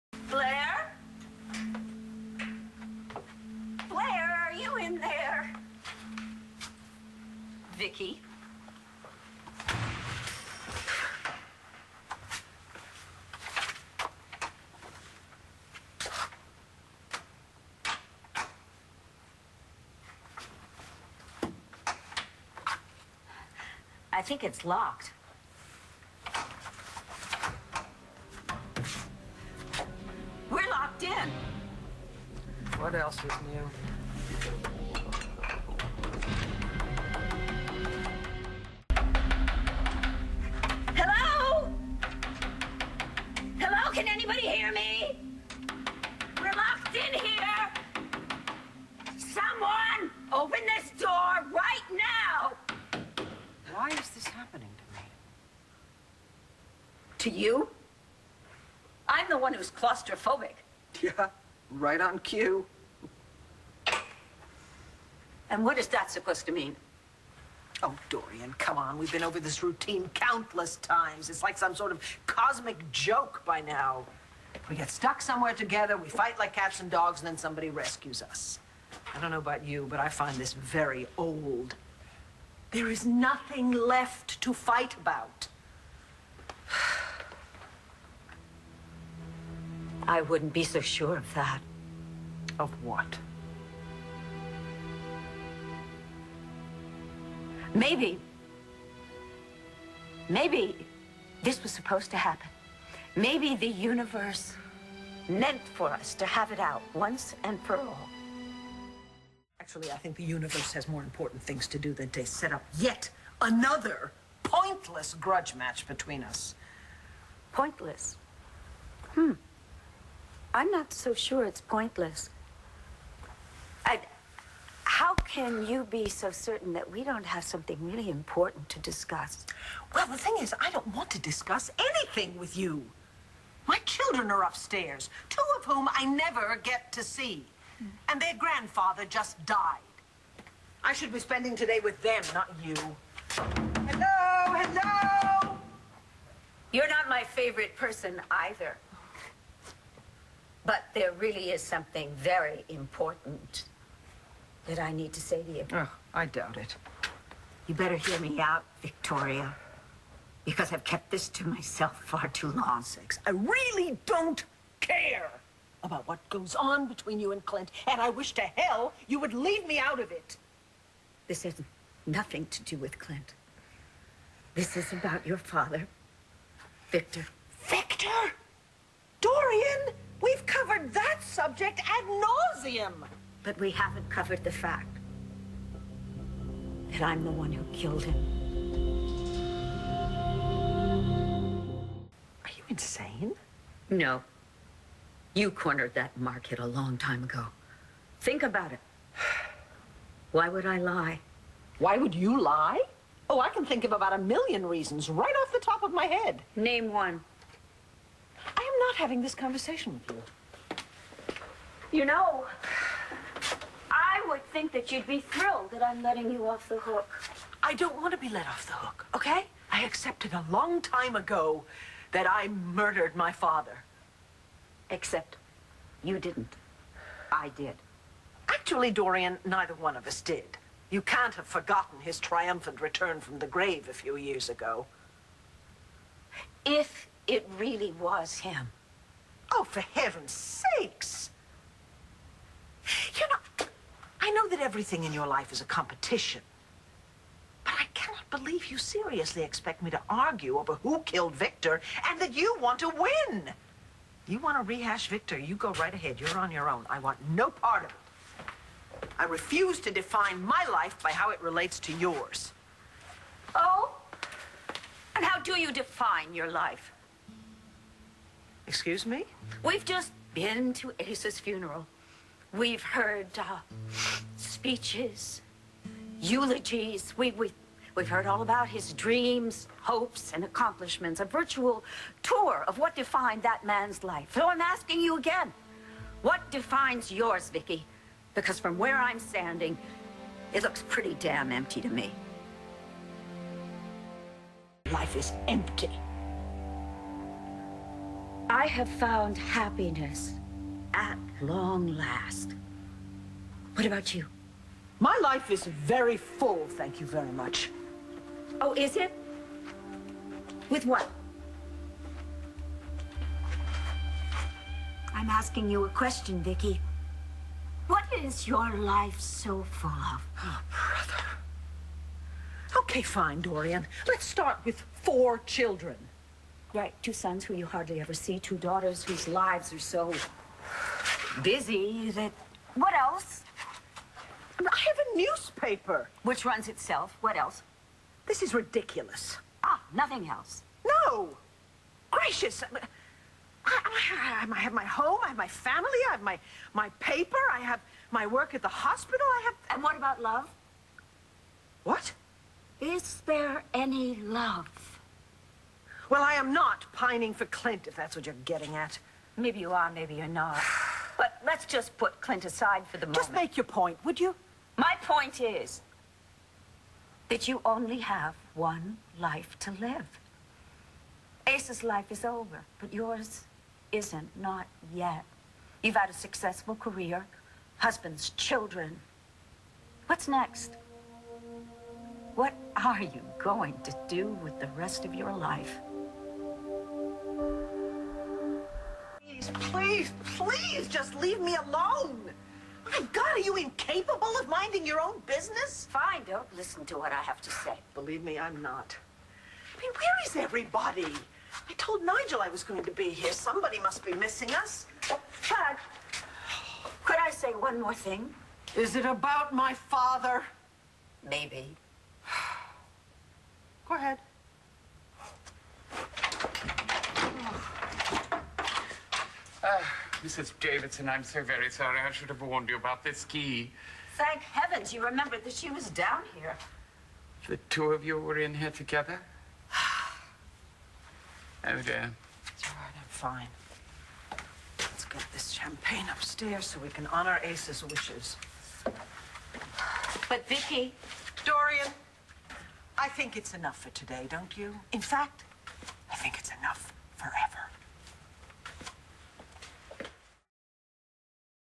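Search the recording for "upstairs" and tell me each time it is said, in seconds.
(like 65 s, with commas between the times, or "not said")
134 s, 436 s.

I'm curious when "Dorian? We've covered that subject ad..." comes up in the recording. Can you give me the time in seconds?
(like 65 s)
179 s.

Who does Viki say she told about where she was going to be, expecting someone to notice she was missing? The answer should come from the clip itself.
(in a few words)
Nigel.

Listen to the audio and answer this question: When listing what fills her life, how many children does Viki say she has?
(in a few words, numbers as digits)
4.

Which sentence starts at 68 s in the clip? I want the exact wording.
We've been over this routine countless times.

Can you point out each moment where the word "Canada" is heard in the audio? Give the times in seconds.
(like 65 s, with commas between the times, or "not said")
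not said.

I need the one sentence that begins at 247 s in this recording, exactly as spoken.
But I cannot believe you seriously expect me to argue over who killed Victor and that you want to win.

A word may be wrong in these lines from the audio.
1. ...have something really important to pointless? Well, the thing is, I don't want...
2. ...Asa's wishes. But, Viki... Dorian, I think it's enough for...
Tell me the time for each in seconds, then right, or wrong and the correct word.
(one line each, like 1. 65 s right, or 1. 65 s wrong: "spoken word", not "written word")
1. 127 s wrong: "discuss", not "pointless"
2. 437 s right.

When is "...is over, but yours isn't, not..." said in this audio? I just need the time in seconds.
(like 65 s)
372 s.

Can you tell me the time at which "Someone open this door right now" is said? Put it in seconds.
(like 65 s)
49 s.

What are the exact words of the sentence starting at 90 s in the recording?
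I wouldn't be so sure of that.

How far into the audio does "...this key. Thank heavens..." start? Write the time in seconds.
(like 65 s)
423 s.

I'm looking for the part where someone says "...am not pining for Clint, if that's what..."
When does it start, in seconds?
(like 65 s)
356 s.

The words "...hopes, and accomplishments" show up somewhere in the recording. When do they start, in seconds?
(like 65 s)
279 s.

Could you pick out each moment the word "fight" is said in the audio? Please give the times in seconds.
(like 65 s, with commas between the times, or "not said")
76 s, 84 s.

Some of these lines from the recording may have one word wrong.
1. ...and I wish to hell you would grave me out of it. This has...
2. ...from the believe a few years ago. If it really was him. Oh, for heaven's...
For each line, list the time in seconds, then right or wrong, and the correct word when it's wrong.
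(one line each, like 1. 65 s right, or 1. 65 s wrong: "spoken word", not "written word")
1. 167 s wrong: "leave", not "grave"
2. 233 s wrong: "grave", not "believe".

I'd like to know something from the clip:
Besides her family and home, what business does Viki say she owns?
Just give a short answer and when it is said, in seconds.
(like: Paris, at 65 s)
A newspaper, at 335 s.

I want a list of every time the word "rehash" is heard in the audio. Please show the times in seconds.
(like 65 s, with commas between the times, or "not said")
254 s.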